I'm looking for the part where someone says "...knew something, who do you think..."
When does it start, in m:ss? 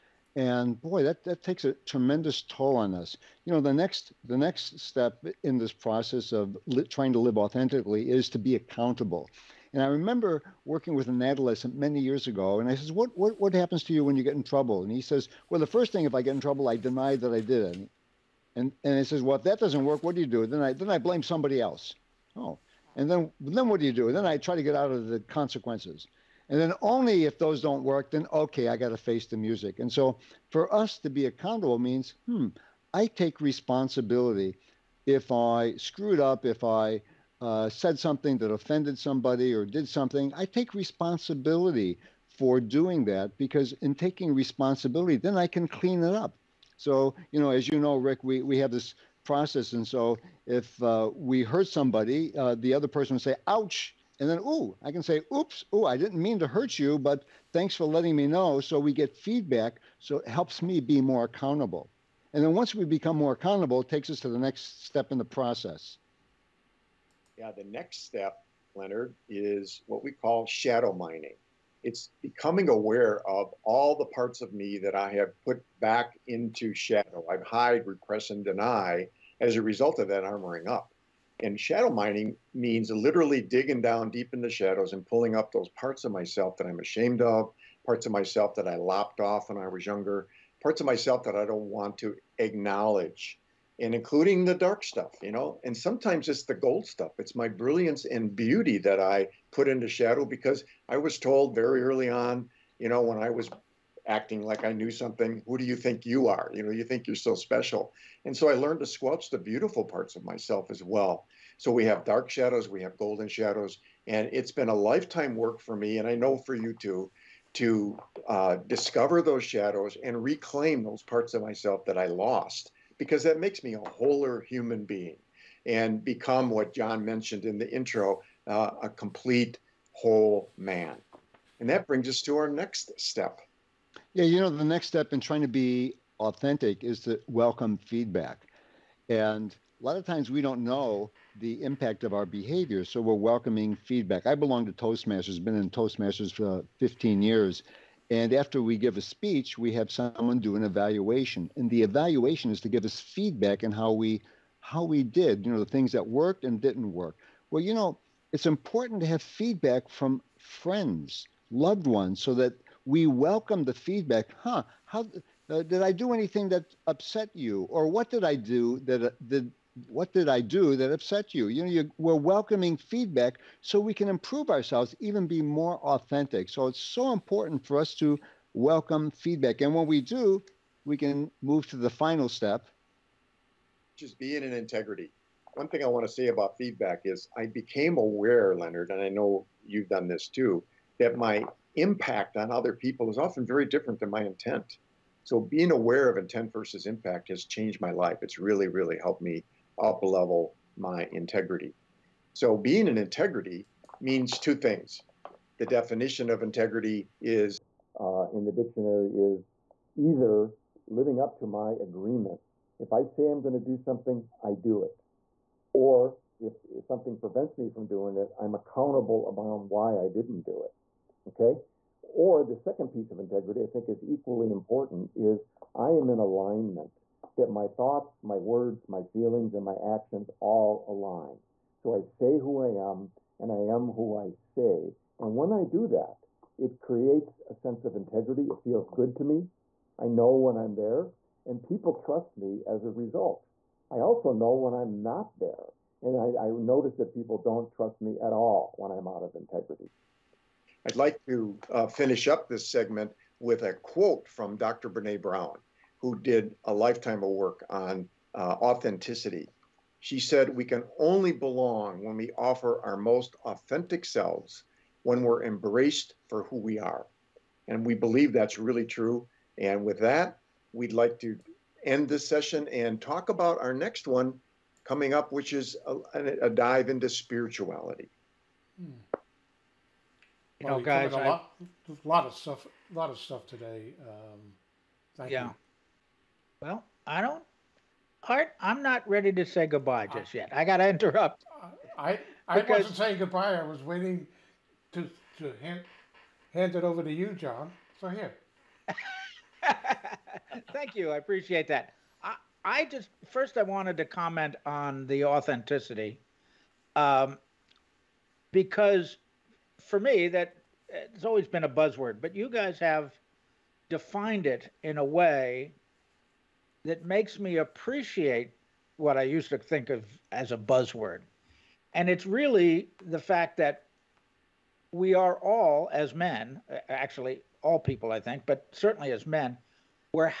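1:44.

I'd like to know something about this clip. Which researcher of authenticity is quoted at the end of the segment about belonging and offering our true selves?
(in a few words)
Brene Brown.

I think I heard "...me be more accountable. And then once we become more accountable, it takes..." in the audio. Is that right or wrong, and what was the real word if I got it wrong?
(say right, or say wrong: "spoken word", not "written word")
right.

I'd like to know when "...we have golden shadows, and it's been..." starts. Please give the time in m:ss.
1:52.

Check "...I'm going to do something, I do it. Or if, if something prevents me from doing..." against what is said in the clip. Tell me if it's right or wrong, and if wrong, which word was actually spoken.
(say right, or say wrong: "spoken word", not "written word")
right.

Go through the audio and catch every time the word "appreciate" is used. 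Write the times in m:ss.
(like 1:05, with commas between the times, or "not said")
5:01, 5:17.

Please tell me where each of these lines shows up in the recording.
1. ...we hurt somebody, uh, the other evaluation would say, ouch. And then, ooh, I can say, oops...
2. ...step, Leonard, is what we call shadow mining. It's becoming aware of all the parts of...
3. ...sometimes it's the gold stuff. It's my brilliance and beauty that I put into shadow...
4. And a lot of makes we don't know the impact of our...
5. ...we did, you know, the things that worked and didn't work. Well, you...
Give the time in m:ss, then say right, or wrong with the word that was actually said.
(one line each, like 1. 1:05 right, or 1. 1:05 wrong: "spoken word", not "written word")
1. 0:51 wrong: "person", not "evaluation"
2. 1:08 right
3. 1:35 right
4. 2:19 wrong: "times", not "makes"
5. 2:34 right.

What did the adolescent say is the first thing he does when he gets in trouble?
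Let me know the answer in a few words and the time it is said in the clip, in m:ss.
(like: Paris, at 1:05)
Deny that I did it, at 0:16.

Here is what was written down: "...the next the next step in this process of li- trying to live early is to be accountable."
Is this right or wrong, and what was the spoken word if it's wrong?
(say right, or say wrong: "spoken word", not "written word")
wrong: "authentically", not "early".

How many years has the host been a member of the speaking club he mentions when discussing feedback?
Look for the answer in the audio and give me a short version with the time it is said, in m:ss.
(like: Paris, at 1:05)
15, at 2:26.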